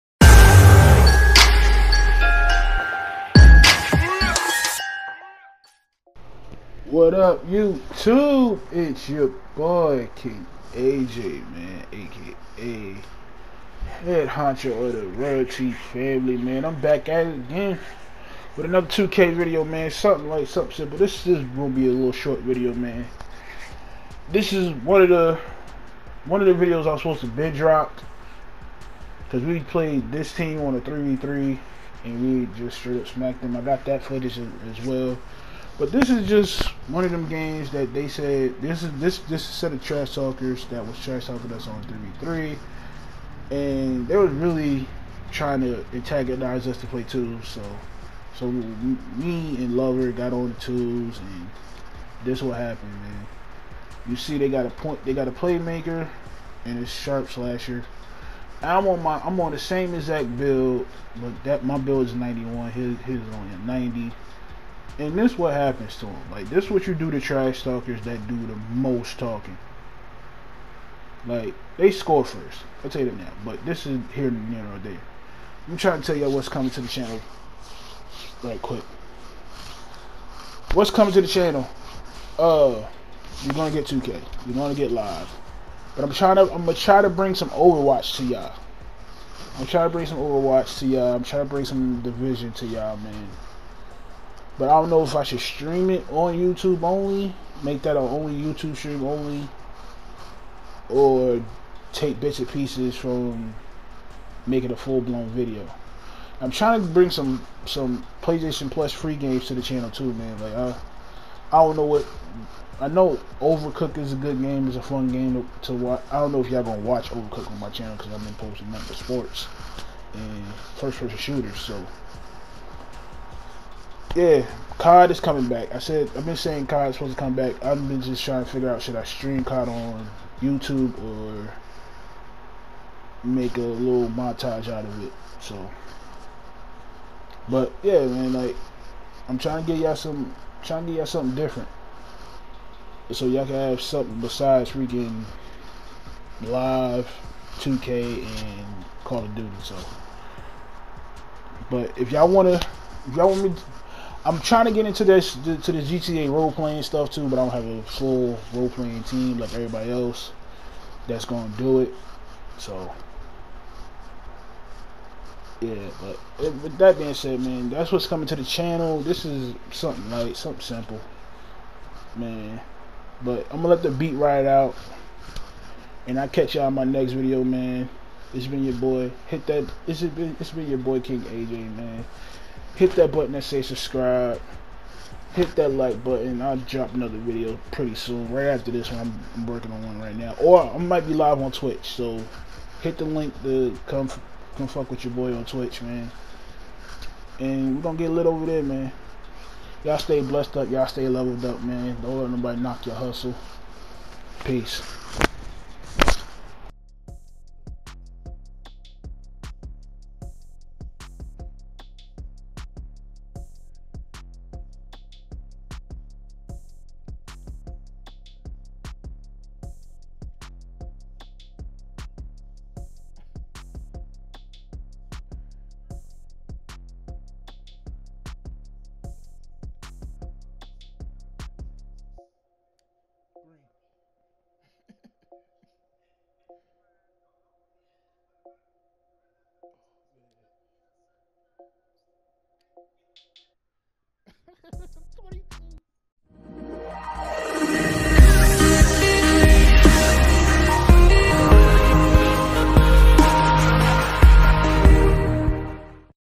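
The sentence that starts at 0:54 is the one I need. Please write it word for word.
You see, they got a point, they got a playmaker, and a sharp slasher.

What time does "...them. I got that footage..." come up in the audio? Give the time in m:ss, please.
0:33.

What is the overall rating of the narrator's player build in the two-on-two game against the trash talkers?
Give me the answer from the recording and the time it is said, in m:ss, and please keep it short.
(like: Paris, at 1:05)
91, at 1:01.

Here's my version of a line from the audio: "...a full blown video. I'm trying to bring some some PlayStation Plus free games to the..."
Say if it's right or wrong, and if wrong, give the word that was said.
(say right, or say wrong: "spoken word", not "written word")
right.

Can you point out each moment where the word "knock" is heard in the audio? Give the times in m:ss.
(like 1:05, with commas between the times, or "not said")
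3:22.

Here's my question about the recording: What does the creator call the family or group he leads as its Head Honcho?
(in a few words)
Royalty Family.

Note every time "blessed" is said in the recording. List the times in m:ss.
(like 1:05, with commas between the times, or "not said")
3:20.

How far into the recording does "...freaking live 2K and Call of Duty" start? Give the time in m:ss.
2:24.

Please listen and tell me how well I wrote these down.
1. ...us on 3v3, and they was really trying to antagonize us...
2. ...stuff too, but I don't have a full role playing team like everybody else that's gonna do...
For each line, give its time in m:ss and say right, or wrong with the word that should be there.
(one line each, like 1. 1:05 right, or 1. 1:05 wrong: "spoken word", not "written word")
1. 0:41 right
2. 2:36 right.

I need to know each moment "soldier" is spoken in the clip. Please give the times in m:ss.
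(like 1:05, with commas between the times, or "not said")
not said.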